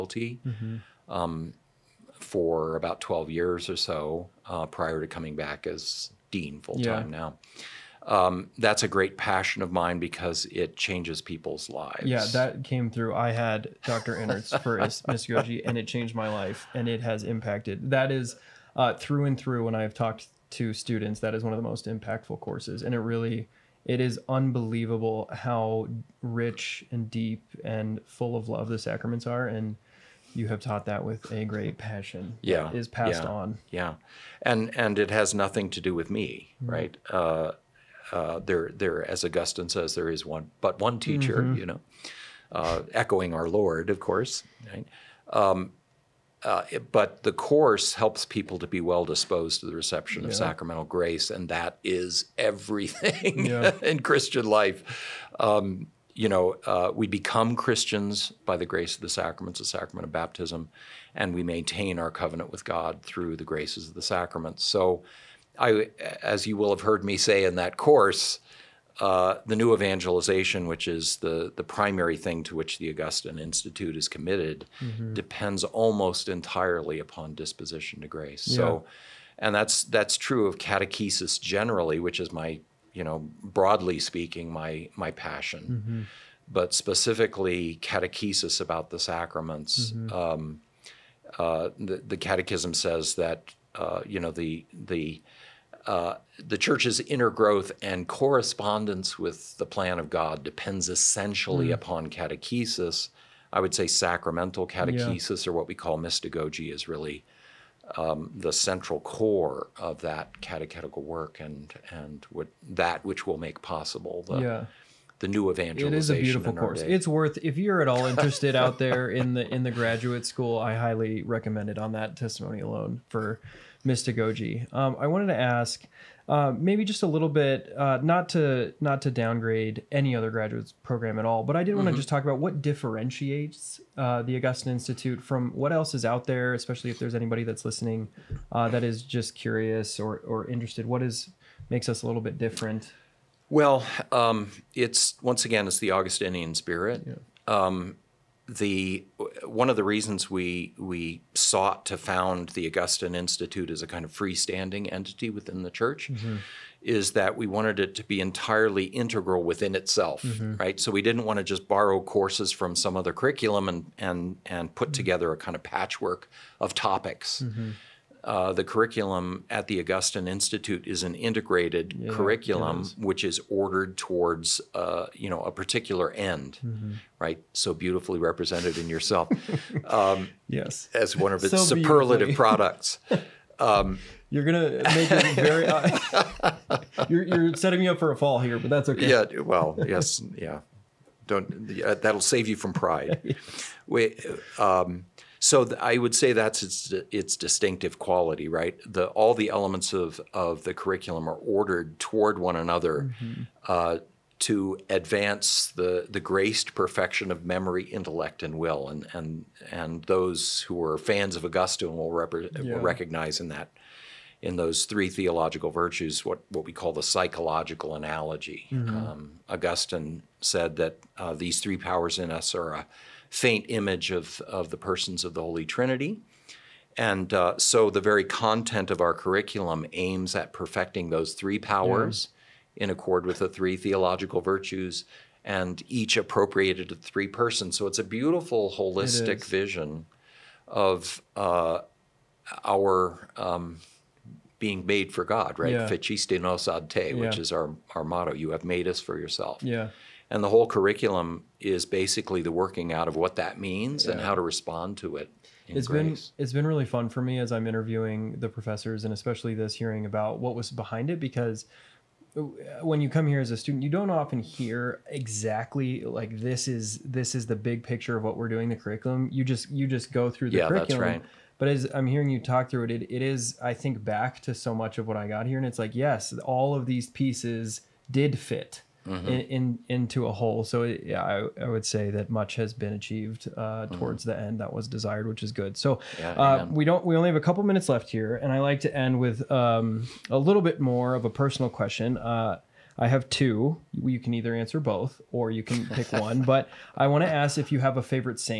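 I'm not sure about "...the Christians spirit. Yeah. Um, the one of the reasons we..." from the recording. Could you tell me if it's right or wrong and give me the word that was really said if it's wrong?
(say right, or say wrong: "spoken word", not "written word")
wrong: "Augustinian", not "Christians".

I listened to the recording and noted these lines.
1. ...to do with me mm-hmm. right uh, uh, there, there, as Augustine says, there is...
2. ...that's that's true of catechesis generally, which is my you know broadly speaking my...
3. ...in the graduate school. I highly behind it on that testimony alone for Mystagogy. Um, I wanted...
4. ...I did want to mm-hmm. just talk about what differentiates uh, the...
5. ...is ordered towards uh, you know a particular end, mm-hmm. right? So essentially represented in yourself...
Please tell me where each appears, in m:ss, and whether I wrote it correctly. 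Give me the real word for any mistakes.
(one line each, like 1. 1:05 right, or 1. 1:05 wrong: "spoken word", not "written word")
1. 0:35 right
2. 1:19 right
3. 1:59 wrong: "recommend", not "behind"
4. 2:11 right
5. 2:53 wrong: "beautifully", not "essentially".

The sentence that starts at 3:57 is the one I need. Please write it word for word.
So it's a beautiful holistic vision of uh, our um, being made for God, right?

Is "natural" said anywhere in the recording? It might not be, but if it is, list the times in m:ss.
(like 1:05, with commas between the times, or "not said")
not said.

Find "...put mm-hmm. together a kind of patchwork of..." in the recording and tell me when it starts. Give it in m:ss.
2:44.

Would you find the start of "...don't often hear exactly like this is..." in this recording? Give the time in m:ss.
4:23.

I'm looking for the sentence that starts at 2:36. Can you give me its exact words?
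is that we wanted it to be entirely integral within itself, mm-hmm.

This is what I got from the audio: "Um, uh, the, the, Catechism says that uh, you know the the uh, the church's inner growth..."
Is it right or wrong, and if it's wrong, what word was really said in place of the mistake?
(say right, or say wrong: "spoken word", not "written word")
right.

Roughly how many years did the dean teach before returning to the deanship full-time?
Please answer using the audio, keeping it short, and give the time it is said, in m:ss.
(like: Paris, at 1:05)
12 years, at 0:03.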